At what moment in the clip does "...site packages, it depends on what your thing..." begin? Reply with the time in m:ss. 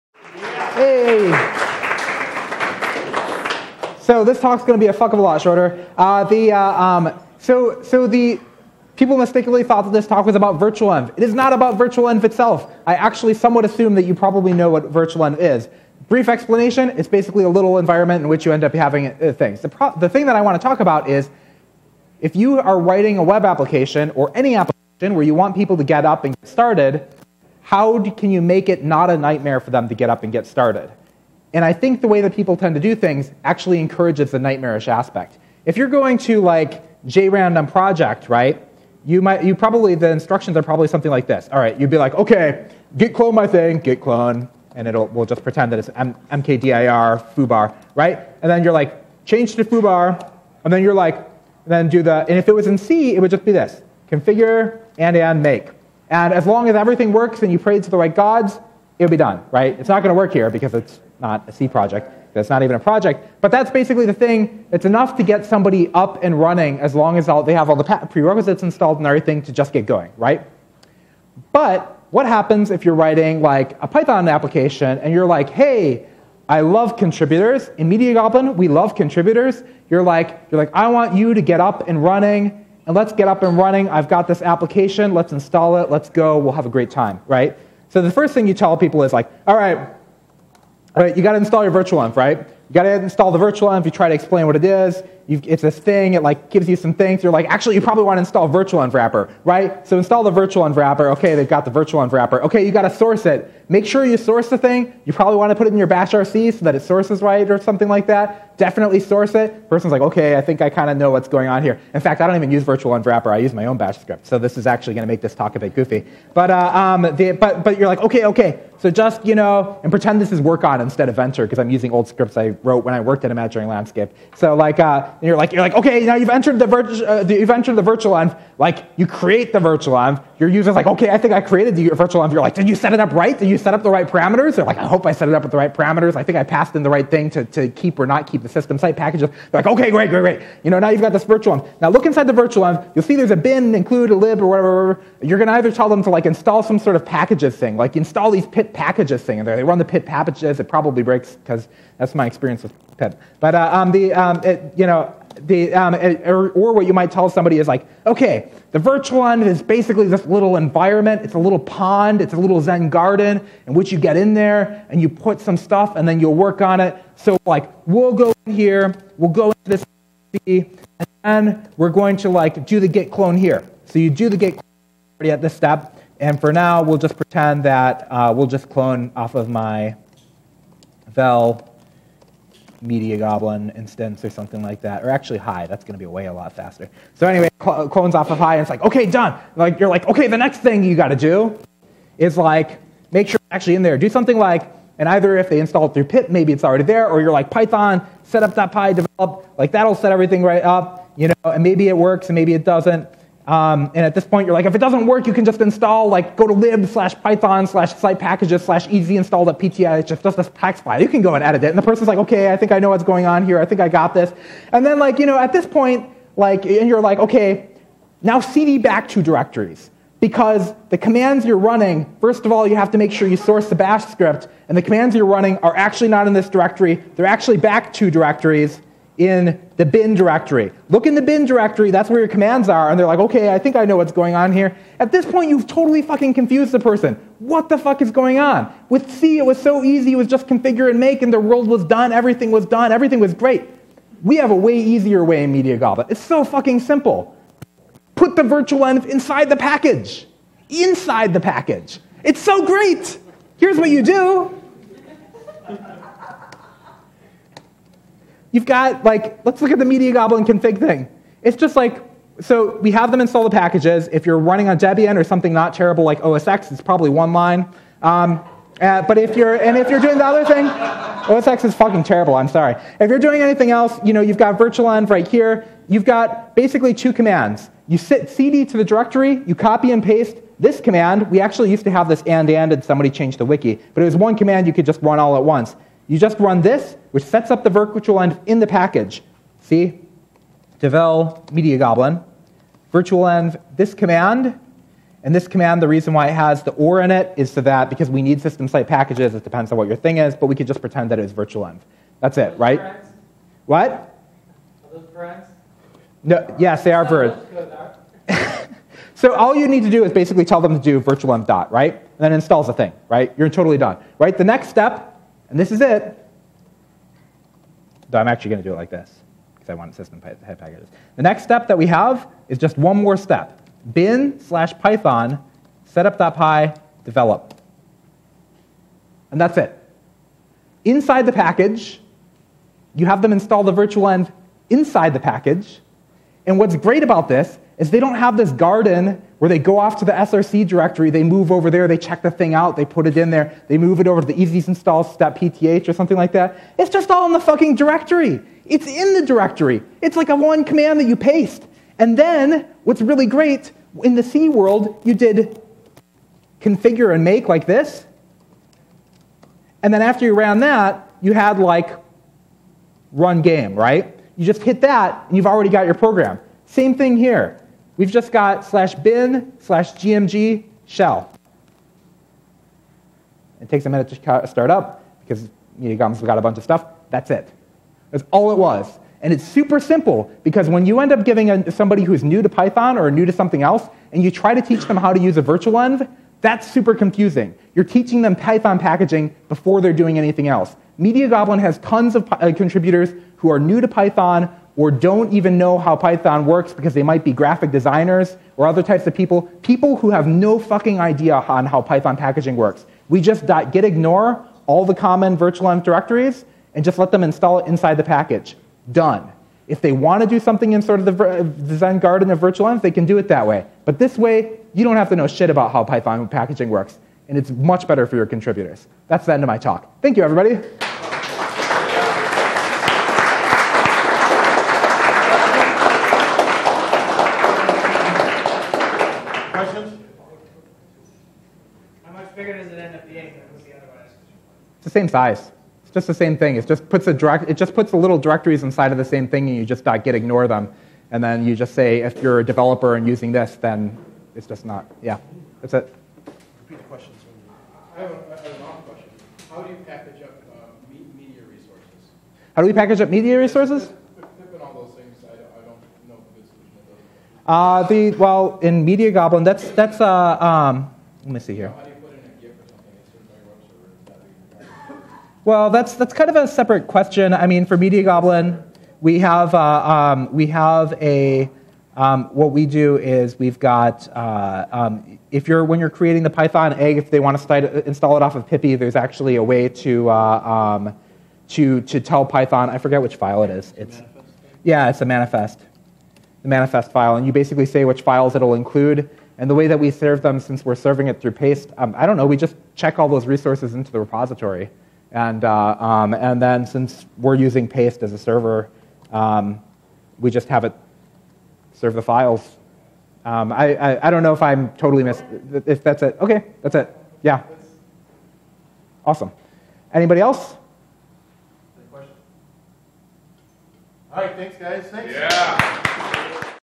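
4:58.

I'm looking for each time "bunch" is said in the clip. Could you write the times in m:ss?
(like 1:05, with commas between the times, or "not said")
6:16.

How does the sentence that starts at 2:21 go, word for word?
Now look inside the virtual env.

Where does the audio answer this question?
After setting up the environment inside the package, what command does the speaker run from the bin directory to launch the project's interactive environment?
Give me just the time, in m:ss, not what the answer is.
6:09.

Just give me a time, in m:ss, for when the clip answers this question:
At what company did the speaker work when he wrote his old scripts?
2:03.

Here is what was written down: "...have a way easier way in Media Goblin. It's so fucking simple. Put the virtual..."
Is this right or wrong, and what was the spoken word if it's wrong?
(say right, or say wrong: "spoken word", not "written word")
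right.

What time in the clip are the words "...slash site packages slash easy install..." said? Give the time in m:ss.
3:27.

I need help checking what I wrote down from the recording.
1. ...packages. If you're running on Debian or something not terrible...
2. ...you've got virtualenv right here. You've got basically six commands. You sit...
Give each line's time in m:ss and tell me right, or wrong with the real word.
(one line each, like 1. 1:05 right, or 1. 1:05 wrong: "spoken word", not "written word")
1. 4:23 right
2. 4:34 wrong: "two", not "six".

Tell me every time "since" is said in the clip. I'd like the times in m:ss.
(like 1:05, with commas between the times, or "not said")
8:10, 8:16.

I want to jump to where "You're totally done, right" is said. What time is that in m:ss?
5:13.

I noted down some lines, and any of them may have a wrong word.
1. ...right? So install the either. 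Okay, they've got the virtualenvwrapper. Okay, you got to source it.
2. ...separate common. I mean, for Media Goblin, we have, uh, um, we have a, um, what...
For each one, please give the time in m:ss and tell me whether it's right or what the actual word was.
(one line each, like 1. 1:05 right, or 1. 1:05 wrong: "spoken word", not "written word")
1. 1:39 wrong: "virtualenvwrapper", not "either"
2. 7:46 wrong: "question", not "common".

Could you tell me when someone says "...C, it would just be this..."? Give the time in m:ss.
0:52.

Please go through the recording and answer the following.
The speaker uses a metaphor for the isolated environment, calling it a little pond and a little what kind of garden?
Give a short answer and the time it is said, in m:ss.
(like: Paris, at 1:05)
Zen garden, at 2:42.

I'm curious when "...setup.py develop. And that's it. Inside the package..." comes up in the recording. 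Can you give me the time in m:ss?
5:25.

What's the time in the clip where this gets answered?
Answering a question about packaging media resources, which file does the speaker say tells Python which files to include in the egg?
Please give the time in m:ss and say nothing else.
8:06.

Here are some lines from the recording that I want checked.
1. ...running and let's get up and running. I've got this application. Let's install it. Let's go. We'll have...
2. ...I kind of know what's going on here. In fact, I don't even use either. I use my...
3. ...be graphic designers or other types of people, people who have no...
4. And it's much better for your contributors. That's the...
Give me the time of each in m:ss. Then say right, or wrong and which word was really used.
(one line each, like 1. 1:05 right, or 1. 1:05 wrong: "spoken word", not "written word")
1. 1:22 right
2. 1:50 wrong: "virtualenvwrapper", not "either"
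3. 6:37 right
4. 6:57 right.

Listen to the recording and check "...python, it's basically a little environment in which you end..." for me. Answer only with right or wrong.
wrong.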